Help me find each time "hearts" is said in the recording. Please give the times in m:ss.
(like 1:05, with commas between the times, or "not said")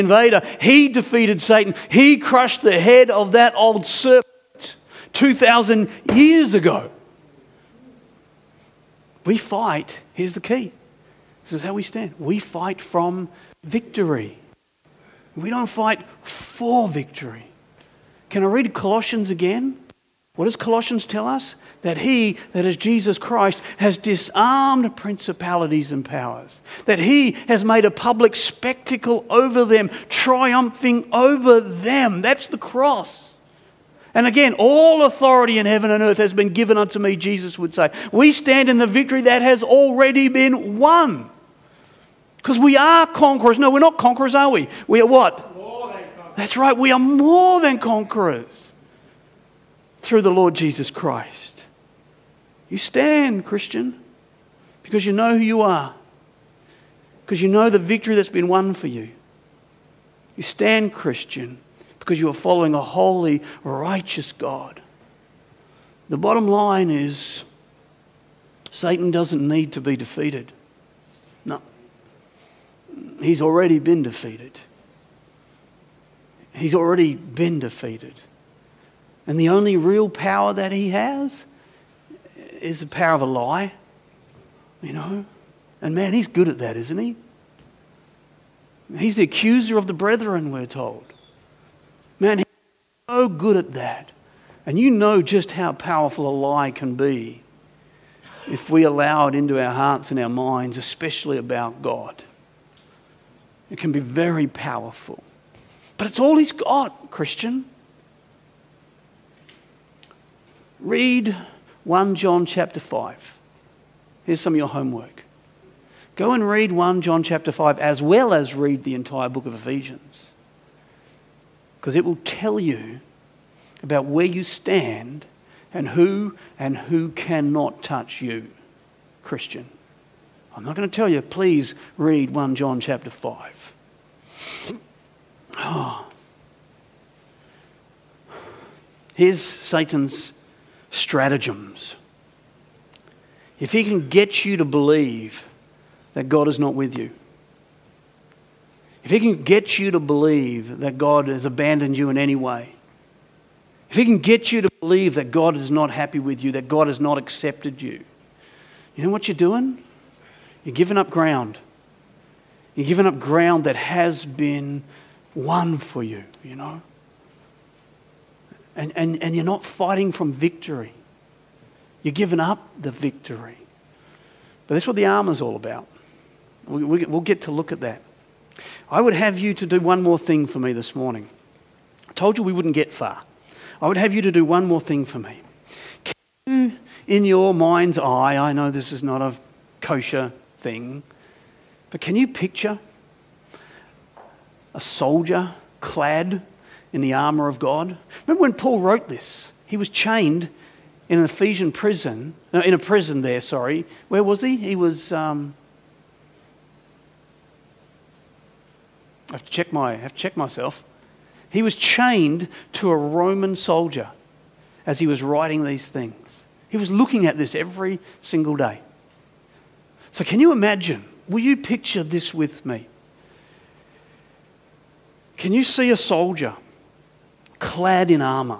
1:39.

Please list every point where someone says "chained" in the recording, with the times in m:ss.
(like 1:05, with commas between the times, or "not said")
3:19, 3:31.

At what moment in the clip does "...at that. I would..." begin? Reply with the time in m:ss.
2:57.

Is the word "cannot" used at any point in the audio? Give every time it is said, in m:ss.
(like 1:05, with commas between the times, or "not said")
2:07.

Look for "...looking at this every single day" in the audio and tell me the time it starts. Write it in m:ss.
3:36.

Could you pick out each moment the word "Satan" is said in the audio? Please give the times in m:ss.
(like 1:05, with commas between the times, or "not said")
0:01, 1:08, 2:19.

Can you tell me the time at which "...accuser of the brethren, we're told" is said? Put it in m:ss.
1:29.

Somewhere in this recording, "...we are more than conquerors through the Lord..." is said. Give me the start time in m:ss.
0:46.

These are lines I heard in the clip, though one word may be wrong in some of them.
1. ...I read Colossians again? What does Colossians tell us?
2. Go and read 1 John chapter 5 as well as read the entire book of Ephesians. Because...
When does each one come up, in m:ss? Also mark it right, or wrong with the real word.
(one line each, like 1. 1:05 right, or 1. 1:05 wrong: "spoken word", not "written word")
1. 0:18 right
2. 1:56 right.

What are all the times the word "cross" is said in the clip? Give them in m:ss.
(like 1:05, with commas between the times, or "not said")
0:32.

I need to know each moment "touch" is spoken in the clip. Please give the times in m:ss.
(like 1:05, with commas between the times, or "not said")
2:07.